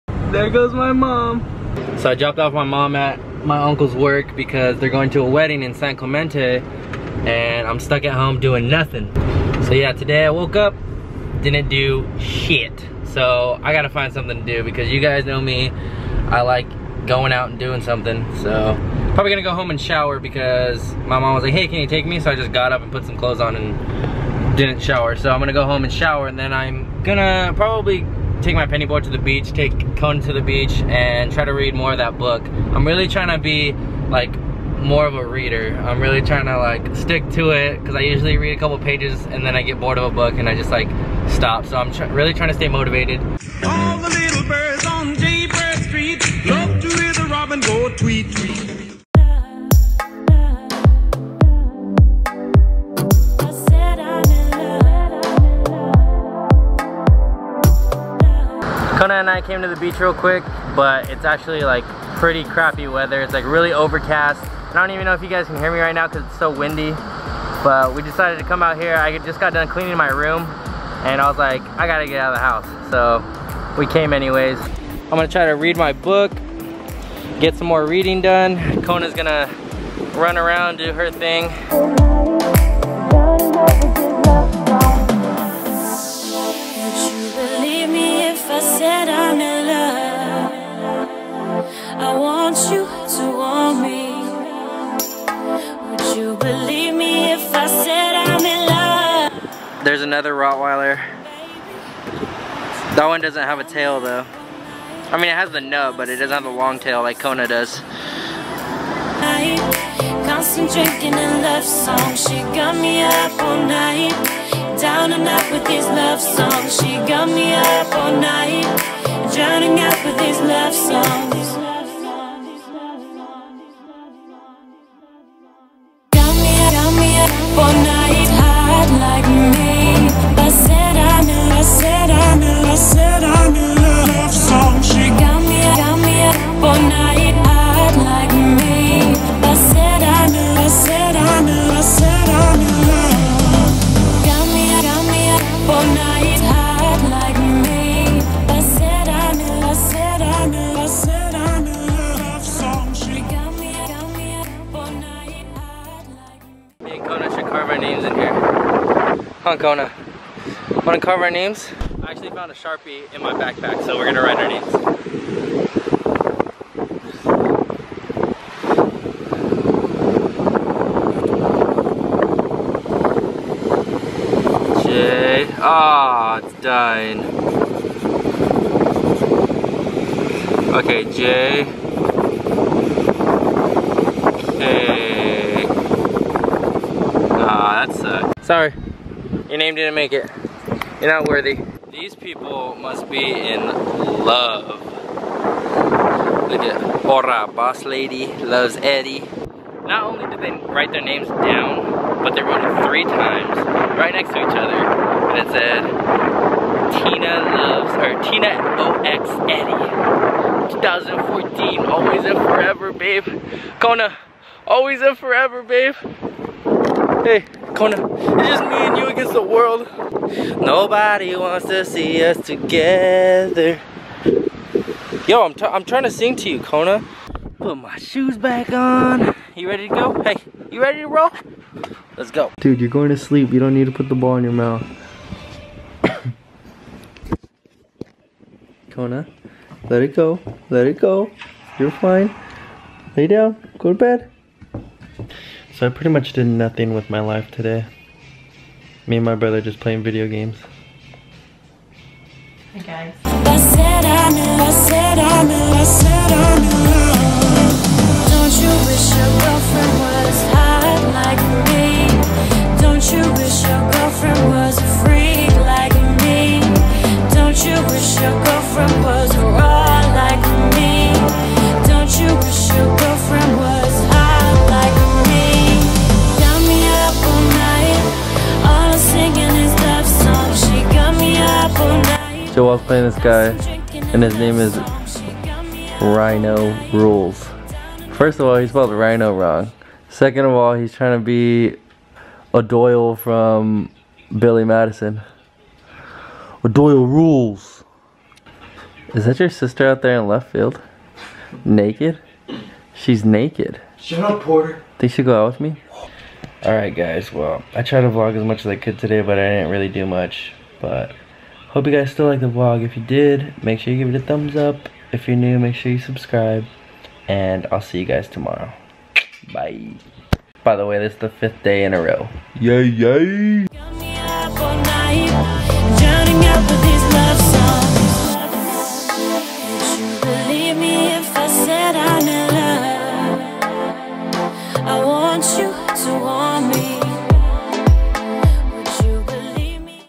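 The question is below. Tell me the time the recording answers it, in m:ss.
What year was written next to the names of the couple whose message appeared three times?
3:30.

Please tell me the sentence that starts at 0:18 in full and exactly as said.
So probably gonna go home and shower because my mom was like, hey, can you take me?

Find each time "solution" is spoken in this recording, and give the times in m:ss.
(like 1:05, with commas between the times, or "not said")
not said.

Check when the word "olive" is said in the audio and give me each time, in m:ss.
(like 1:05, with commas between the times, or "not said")
not said.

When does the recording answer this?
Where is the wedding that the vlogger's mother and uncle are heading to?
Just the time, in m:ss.
0:05.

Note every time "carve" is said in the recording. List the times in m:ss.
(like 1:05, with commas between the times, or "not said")
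2:41.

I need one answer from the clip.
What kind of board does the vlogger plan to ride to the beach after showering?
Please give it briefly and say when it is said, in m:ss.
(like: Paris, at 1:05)
Penny board, at 0:28.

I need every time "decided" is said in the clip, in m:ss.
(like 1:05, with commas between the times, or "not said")
1:08.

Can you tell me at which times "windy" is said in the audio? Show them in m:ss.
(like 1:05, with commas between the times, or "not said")
1:06.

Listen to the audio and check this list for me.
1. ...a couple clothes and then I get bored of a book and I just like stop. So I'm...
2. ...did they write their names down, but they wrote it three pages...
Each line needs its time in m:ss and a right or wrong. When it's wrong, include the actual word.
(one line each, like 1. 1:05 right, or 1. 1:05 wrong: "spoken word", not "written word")
1. 0:38 wrong: "pages", not "clothes"
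2. 3:20 wrong: "times", not "pages".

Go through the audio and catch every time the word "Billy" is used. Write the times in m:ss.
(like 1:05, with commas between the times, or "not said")
4:54.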